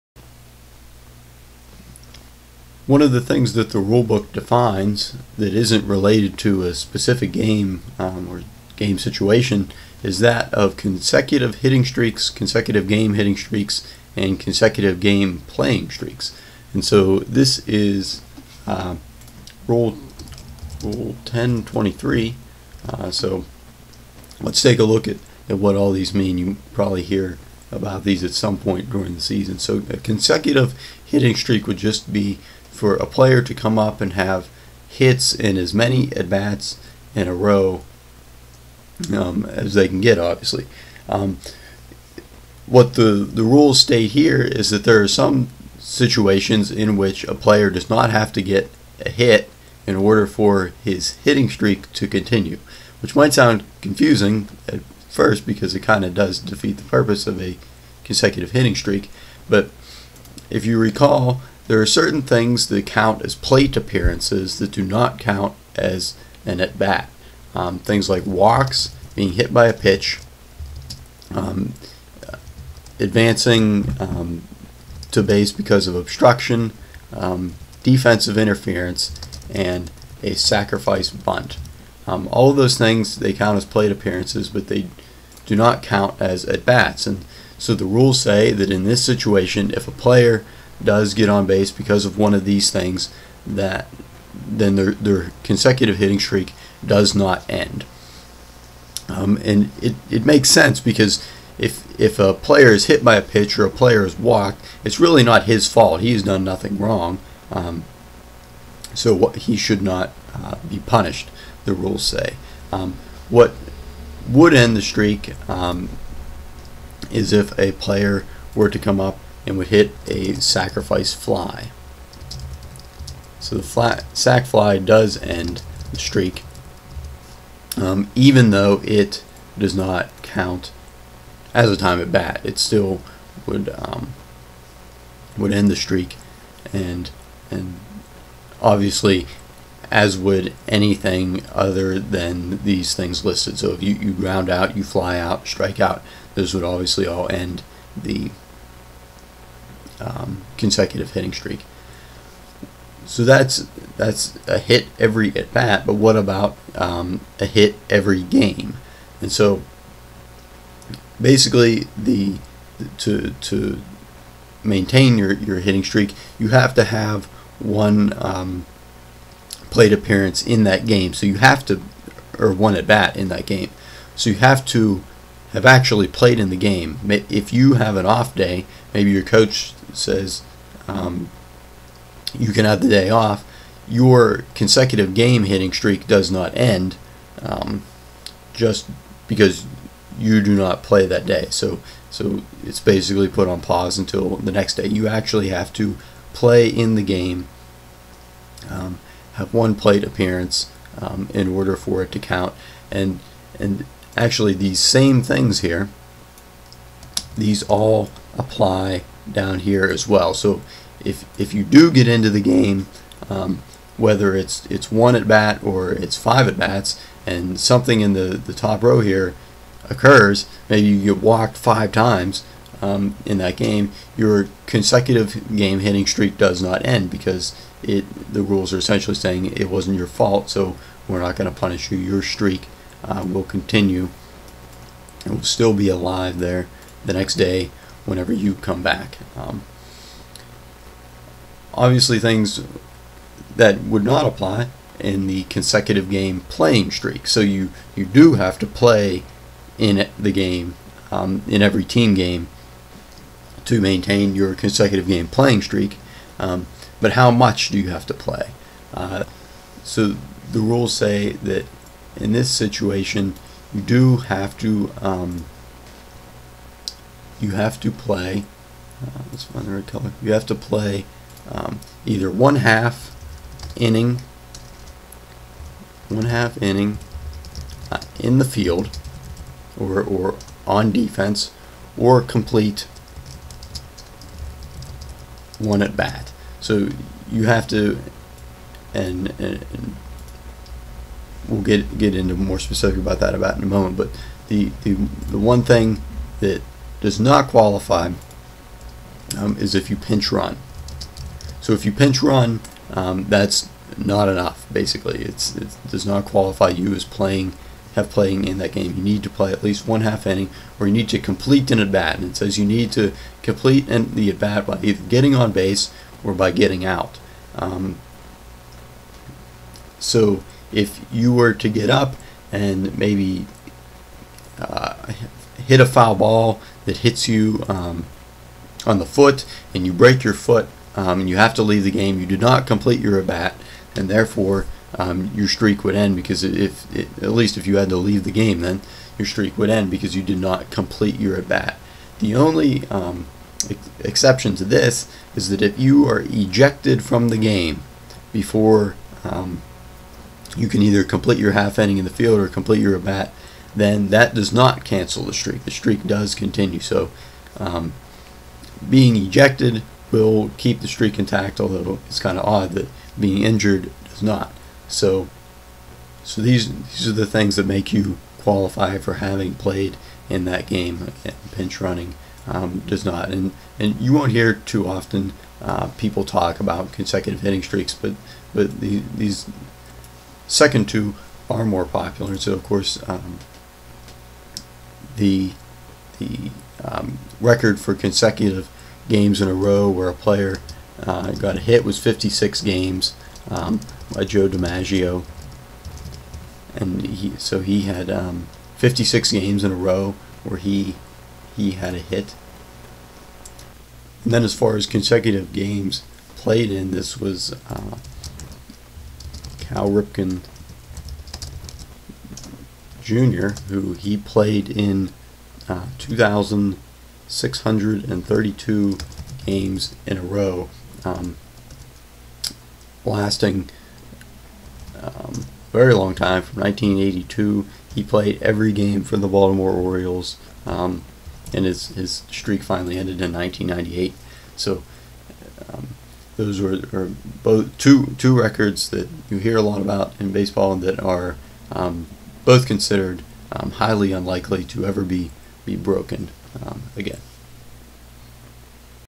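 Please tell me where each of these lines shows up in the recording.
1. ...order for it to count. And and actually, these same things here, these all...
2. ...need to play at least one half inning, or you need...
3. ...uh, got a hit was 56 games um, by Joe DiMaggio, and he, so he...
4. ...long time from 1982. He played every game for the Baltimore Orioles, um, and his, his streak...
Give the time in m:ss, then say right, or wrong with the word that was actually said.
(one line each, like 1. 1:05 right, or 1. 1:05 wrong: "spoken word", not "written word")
1. 3:21 right
2. 5:09 right
3. 6:31 right
4. 7:05 right.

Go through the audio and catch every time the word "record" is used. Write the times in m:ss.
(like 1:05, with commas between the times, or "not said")
6:27, 7:18.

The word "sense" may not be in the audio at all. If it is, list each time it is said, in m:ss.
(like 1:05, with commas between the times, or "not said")
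1:40.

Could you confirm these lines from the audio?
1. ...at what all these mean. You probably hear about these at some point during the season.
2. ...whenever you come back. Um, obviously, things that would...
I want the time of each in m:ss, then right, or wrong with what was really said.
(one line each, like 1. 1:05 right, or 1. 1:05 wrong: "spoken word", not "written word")
1. 0:25 right
2. 3:58 right.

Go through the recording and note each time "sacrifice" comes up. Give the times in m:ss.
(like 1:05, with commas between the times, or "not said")
1:20, 2:00.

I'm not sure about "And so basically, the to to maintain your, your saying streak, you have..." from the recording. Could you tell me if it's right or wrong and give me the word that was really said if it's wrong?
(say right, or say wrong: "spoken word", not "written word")
wrong: "hitting", not "saying".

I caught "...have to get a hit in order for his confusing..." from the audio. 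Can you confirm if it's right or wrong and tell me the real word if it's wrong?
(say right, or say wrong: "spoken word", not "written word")
wrong: "hitting", not "confusing".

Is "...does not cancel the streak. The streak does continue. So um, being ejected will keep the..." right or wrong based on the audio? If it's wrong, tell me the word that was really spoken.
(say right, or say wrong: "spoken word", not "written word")
right.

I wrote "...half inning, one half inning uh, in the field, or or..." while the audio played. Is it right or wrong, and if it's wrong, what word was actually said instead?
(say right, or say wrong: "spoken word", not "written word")
right.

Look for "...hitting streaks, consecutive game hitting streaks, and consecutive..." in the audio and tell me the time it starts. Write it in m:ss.
0:11.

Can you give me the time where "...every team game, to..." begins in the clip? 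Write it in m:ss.
4:11.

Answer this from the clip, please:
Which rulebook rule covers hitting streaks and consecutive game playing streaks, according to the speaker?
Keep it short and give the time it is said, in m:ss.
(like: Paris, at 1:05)
Rule 1023, at 0:20.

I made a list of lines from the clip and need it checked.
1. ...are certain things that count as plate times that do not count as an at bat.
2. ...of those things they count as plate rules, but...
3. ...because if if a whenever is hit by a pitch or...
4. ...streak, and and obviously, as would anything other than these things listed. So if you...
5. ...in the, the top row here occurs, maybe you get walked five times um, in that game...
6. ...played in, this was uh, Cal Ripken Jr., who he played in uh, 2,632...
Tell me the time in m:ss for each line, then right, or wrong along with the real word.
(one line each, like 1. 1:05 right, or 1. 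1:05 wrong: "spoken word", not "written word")
1. 1:01 wrong: "appearances", not "times"
2. 1:22 wrong: "appearances", not "rules"
3. 1:40 wrong: "player", not "whenever"
4. 2:15 right
5. 3:38 right
6. 6:46 right.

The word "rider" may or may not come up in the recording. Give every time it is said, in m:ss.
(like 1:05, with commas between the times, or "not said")
not said.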